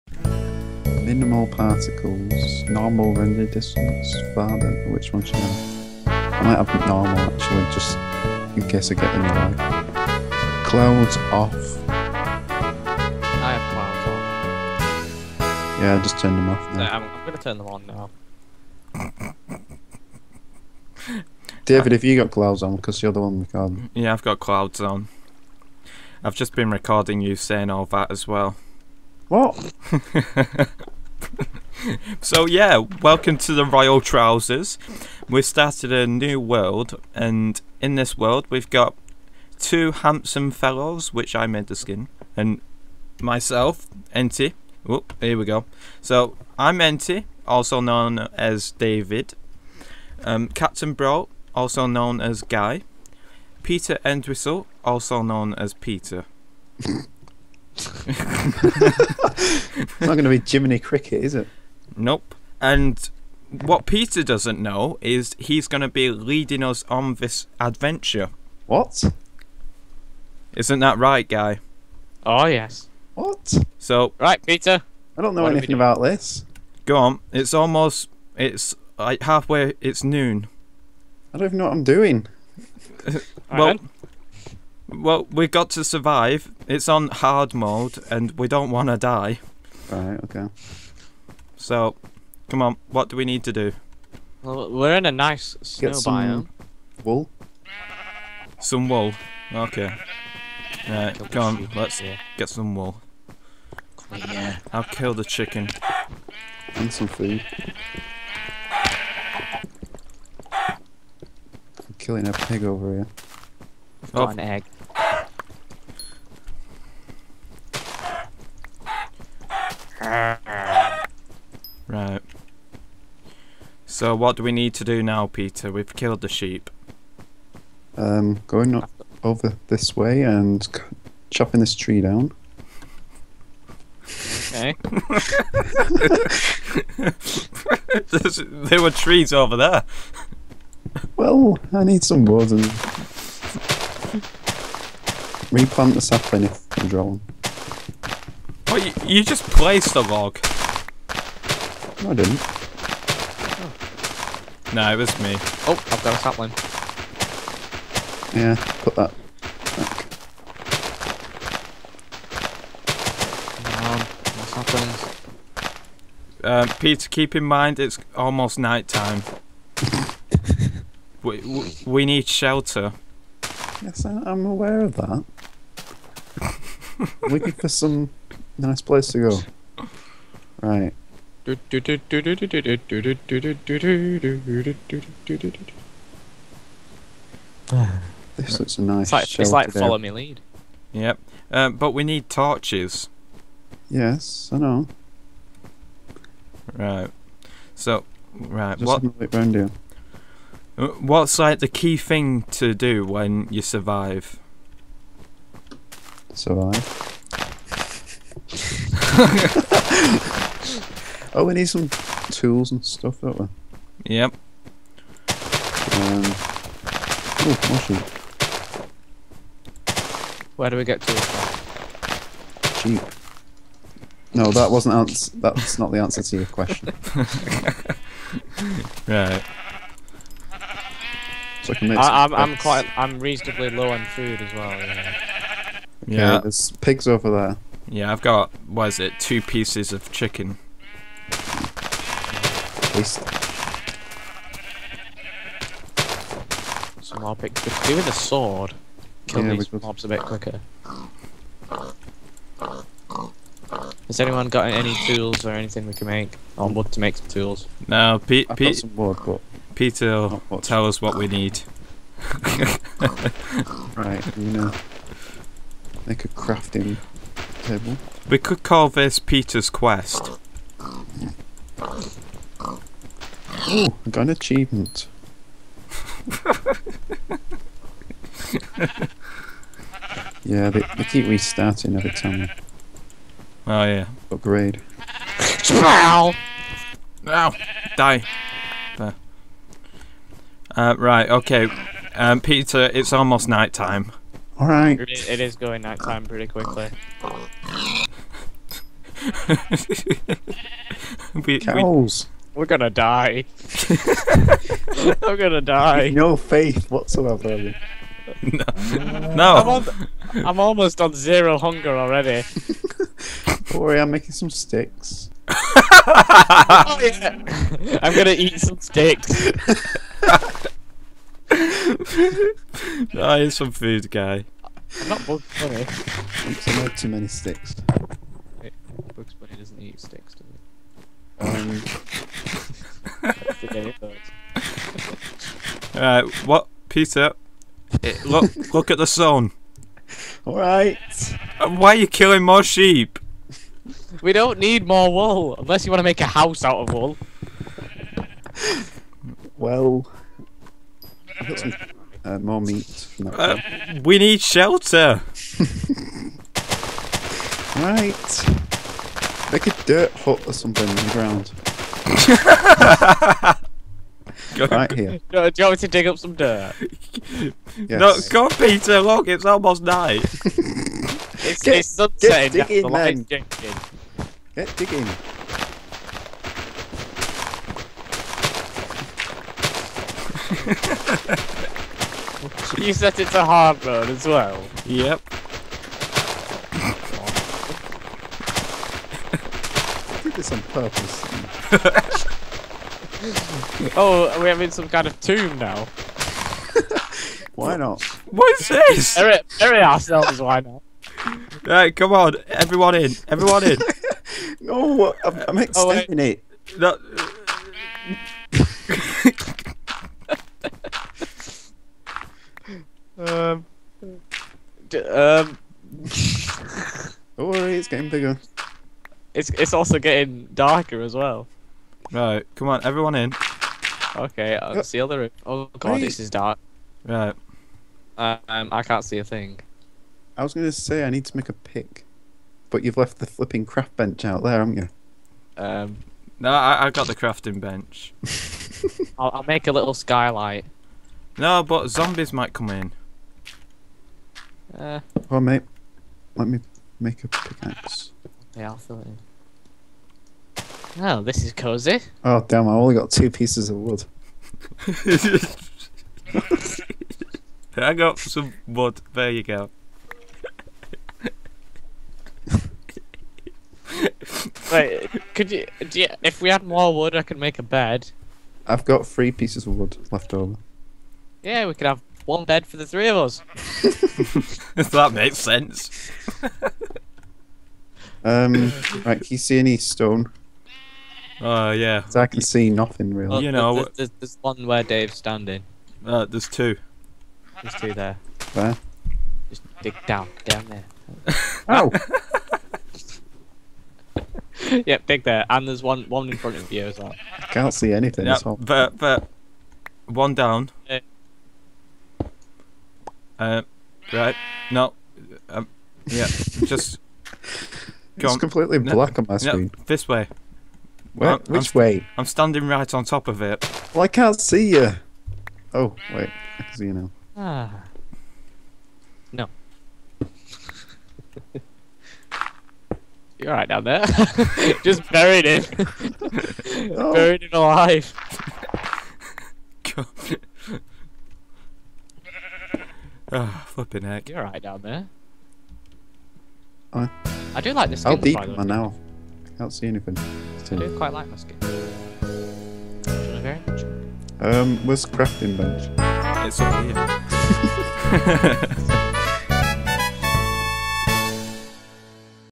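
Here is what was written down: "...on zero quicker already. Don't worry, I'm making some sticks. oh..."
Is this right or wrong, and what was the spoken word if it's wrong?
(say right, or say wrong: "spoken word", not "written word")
wrong: "hunger", not "quicker".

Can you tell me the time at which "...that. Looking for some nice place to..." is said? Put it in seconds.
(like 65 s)
174 s.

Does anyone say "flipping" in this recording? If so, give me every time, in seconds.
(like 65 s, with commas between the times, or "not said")
433 s, 533 s.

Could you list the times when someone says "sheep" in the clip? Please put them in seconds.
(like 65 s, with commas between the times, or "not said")
126 s, 342 s.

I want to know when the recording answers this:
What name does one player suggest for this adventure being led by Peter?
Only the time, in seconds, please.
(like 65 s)
269 s.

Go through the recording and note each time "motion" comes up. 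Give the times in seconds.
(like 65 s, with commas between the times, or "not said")
not said.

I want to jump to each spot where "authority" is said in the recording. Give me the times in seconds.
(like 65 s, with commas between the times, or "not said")
not said.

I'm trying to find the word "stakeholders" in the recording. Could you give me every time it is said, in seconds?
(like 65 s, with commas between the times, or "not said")
not said.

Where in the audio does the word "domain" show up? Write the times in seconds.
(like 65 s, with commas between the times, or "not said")
not said.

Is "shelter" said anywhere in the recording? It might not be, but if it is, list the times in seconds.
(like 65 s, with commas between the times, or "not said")
172 s, 354 s.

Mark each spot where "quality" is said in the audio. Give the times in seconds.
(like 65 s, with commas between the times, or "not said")
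not said.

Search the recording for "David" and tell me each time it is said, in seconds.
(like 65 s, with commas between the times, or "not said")
21 s, 48 s.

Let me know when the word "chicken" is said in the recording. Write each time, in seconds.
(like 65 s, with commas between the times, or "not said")
105 s, 240 s.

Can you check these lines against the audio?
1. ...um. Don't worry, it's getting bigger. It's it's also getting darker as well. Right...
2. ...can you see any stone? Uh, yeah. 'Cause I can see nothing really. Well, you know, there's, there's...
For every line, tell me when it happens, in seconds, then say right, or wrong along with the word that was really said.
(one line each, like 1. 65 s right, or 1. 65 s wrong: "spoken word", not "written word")
1. 415 s right
2. 479 s right.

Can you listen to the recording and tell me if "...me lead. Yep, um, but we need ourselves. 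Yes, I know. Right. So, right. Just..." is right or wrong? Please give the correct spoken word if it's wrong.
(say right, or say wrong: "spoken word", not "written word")
wrong: "torches", not "ourselves".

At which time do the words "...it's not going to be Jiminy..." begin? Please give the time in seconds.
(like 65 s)
57 s.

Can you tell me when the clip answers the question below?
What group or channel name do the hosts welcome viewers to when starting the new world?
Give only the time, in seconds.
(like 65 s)
33 s.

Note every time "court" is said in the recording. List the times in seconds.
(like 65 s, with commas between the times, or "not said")
not said.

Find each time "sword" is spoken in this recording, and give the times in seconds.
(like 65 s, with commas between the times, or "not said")
248 s.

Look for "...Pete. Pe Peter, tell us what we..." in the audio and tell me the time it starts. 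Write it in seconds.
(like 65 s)
258 s.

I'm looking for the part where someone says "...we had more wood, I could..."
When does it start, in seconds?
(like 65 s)
466 s.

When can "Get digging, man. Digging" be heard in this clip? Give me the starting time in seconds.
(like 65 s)
372 s.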